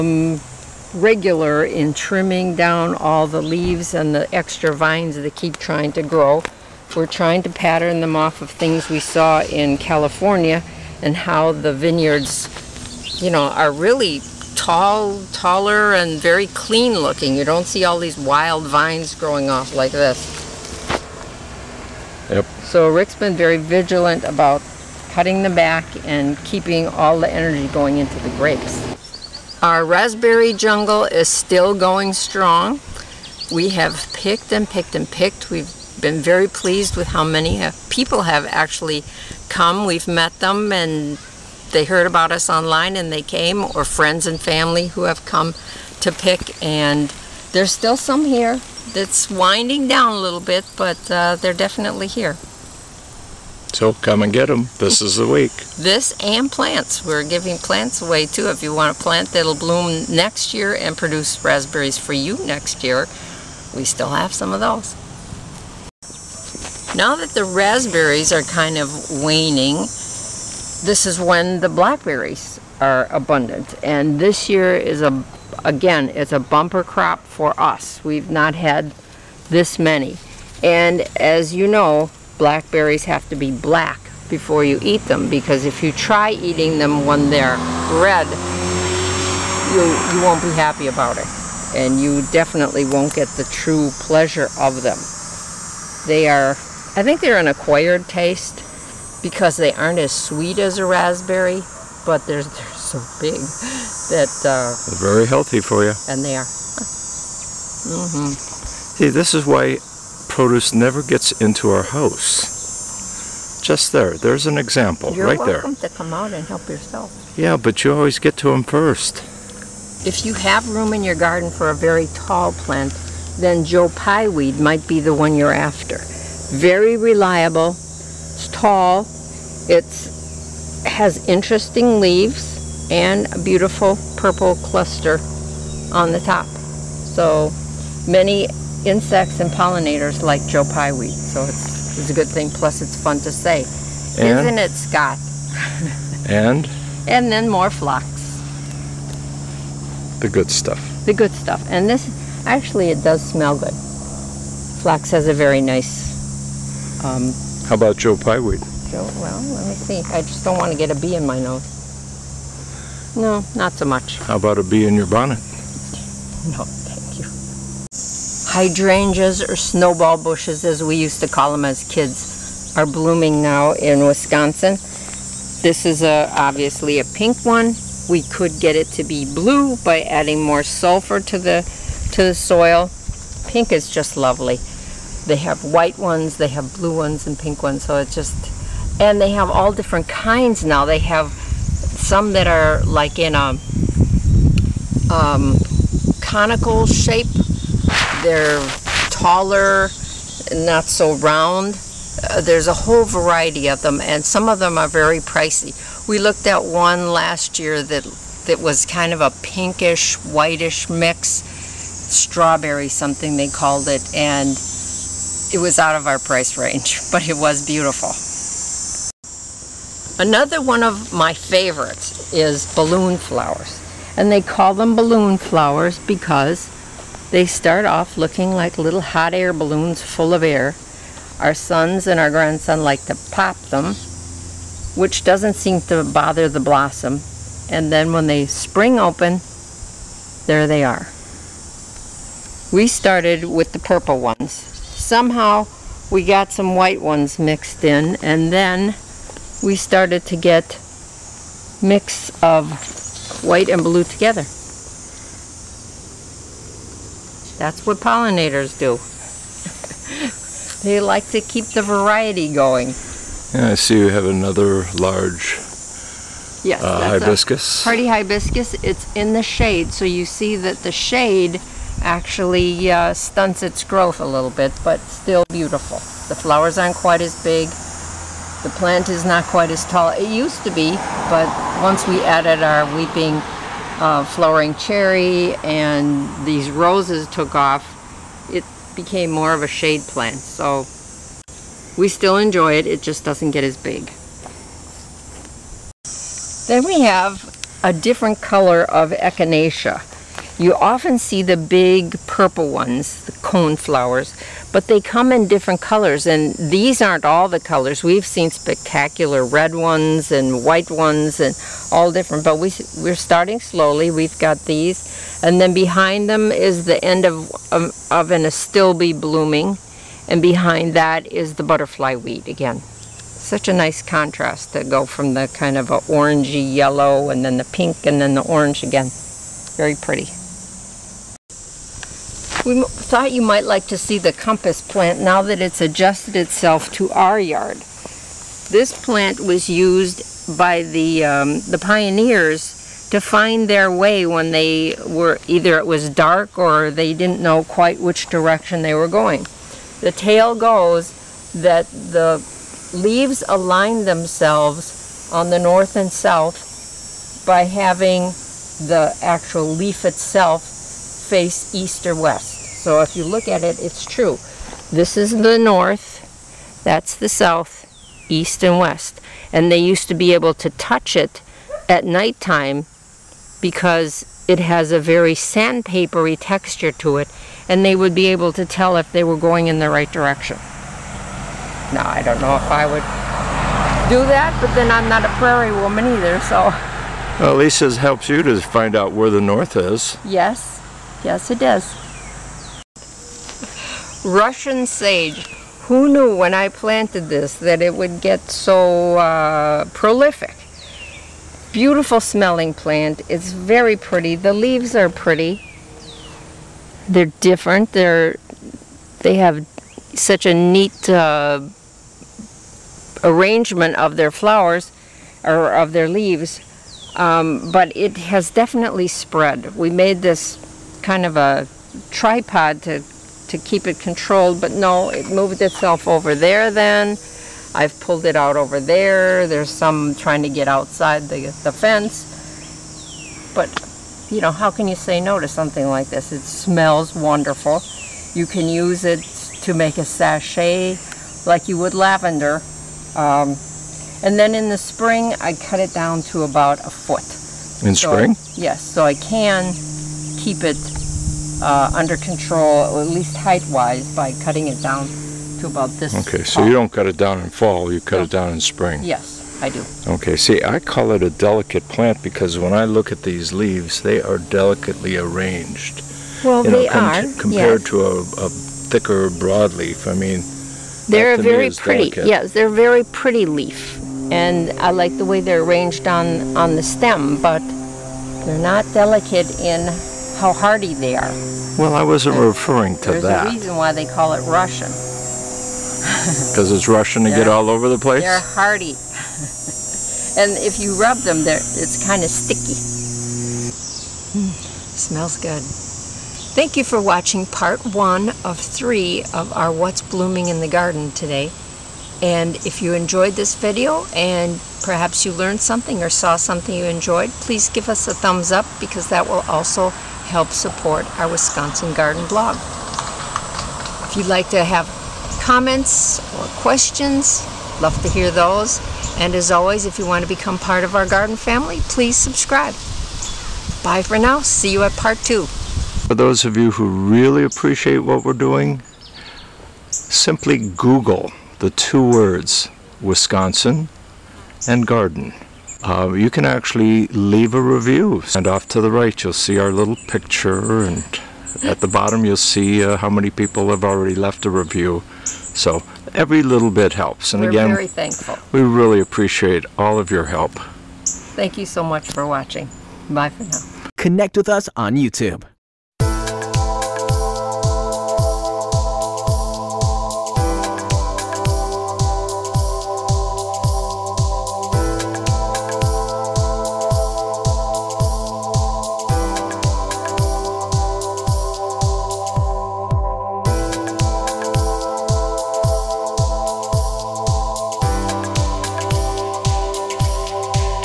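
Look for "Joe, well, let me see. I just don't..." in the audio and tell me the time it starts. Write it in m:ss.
2:38.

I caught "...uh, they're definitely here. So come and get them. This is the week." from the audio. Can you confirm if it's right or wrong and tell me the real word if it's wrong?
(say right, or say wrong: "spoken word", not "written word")
right.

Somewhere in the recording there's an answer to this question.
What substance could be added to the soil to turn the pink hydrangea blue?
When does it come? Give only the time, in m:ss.
3:00.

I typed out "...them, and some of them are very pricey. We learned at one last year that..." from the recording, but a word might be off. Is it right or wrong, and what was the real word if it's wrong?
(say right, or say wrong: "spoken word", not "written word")
wrong: "looked", not "learned".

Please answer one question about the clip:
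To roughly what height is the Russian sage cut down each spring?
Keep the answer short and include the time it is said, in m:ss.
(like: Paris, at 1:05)
about a foot, at 7:26.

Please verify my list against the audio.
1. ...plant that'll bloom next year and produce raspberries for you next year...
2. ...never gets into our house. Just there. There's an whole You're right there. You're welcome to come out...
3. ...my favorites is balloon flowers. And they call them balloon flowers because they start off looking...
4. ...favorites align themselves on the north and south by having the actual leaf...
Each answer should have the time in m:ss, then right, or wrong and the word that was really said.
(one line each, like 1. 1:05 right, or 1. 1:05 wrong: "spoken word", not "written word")
1. 0:59 right
2. 1:50 wrong: "example", not "whole"
3. 3:41 right
4. 5:52 wrong: "leaves", not "favorites".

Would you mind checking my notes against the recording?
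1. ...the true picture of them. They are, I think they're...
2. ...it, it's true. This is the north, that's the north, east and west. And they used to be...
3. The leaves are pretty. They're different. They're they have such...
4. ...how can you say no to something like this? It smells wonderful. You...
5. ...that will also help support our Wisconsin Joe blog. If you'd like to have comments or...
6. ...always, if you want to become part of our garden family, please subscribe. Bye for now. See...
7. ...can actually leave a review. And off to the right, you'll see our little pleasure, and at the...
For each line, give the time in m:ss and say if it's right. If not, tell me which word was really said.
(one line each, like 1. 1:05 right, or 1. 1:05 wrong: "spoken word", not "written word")
1. 1:33 wrong: "pleasure", not "picture"
2. 6:03 wrong: "south", not "north"
3. 6:44 right
4. 7:14 right
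5. 8:29 wrong: "Garden", not "Joe"
6. 8:39 right
7. 8:56 wrong: "picture", not "pleasure".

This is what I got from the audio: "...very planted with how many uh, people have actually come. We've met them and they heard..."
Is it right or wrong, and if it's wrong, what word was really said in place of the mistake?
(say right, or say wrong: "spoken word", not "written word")
wrong: "pleased", not "planted".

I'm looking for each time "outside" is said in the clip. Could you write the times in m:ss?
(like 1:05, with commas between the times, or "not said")
7:10.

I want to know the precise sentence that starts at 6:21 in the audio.
Now, I don't know if I would do that, but then I'm not a prairie woman either, so.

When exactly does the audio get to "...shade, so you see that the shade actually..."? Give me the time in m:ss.
4:29.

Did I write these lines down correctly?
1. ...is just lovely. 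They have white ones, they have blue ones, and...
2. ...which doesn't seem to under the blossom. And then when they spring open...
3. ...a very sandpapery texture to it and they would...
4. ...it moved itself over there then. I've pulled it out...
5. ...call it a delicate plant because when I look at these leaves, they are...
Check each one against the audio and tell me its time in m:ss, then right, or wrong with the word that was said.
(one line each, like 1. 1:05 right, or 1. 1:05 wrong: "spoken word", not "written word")
1. 3:03 right
2. 3:54 wrong: "bother", not "under"
3. 6:14 right
4. 7:05 right
5. 7:40 right.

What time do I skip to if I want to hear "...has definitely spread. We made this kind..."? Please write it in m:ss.
6:58.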